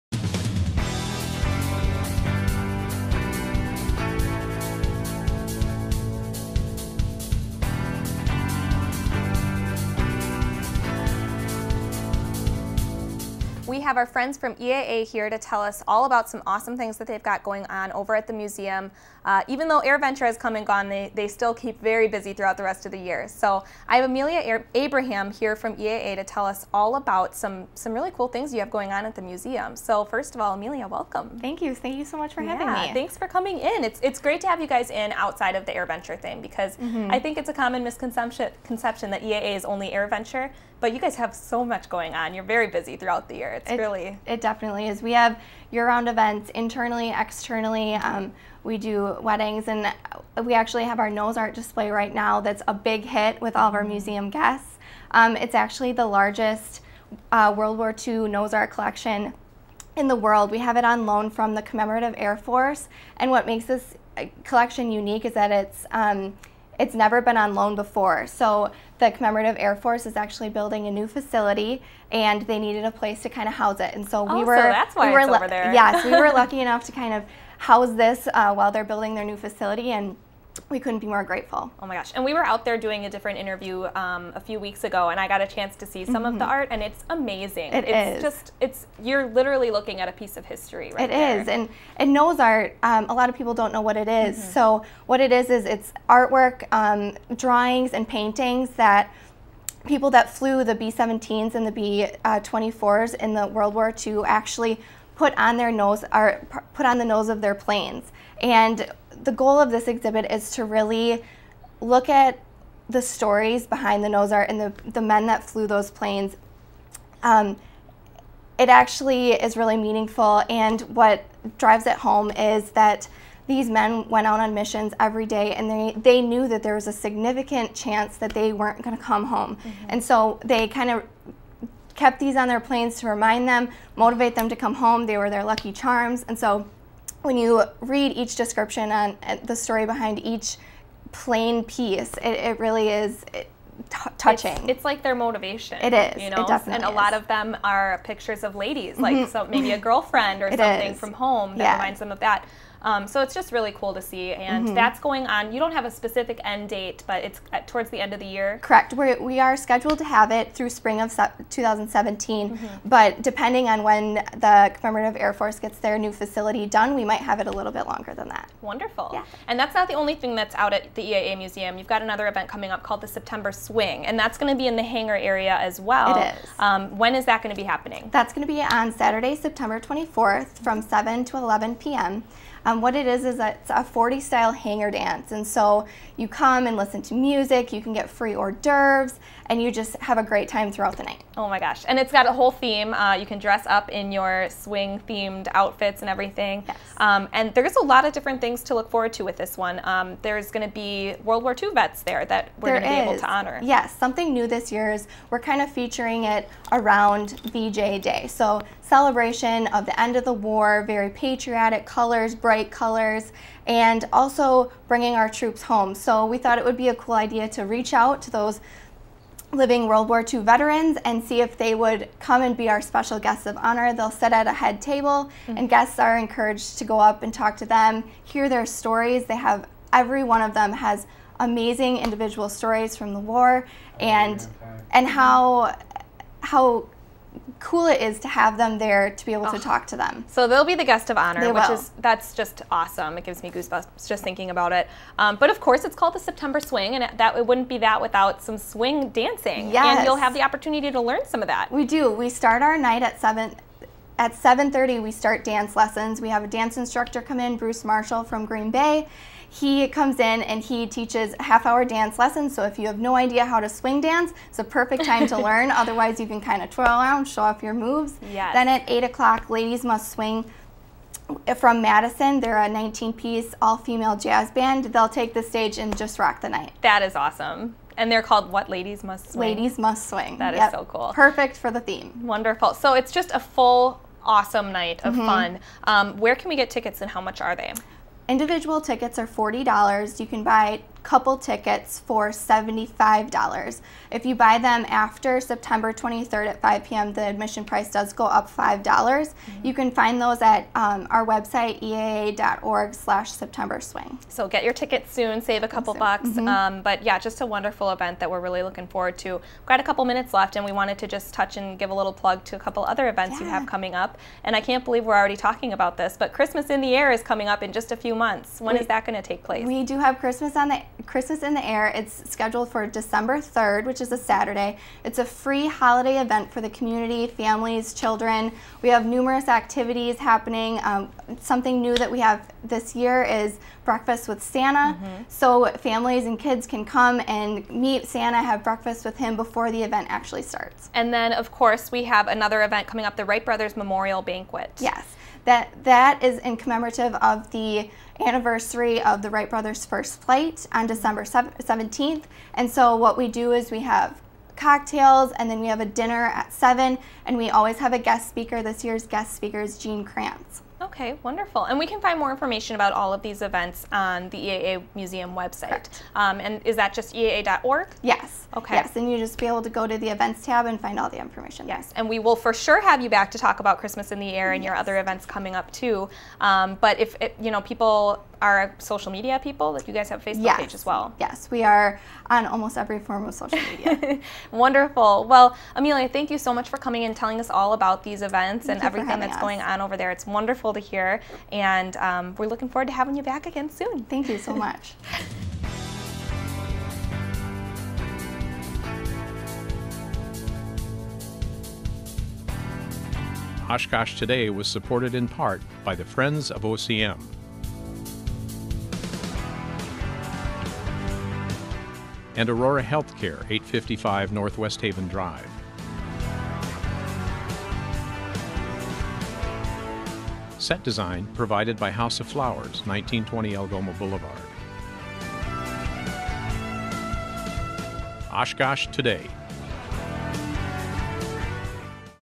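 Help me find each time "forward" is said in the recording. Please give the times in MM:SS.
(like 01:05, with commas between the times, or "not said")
03:18, 05:08, 06:32.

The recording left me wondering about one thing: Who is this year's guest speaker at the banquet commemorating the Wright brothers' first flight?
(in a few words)
Gene Kranz.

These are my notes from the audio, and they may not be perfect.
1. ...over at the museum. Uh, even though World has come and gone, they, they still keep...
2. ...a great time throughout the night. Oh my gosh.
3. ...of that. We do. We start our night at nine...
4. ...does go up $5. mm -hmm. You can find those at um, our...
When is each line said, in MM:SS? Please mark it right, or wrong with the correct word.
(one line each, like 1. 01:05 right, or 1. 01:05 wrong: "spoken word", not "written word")
1. 00:17 wrong: "AirVenture", not "World"
2. 03:10 right
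3. 04:11 wrong: "seven", not "nine"
4. 04:57 right.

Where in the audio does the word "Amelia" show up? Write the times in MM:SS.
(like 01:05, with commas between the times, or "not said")
00:24, 00:30, 06:25.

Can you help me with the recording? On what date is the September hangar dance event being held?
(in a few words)
September 24th.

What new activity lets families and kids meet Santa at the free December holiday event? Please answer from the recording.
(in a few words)
breakfast with Santa.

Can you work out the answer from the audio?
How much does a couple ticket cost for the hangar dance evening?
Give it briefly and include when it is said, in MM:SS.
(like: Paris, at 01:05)
$75, at 04:52.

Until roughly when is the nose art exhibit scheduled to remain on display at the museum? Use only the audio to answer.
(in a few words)
spring of 2017.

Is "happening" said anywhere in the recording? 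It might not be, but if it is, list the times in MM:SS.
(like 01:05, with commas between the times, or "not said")
02:57, 05:30.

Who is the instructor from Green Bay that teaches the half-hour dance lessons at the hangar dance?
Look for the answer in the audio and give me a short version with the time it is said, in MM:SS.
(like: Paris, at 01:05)
Bruce Marshall, at 04:17.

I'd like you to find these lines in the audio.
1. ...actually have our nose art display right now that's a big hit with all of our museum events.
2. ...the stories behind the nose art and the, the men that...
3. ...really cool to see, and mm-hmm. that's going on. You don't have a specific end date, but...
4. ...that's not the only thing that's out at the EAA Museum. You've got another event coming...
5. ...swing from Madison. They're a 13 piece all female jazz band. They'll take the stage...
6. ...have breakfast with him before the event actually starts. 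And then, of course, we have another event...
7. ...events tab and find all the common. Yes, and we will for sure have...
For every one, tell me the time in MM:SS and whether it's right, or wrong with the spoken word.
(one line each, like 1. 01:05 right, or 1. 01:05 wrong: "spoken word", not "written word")
1. 00:50 wrong: "guests", not "events"
2. 01:52 right
3. 02:33 right
4. 02:49 right
5. 04:30 wrong: "19", not "13"
6. 05:38 right
7. 06:10 wrong: "information", not "common".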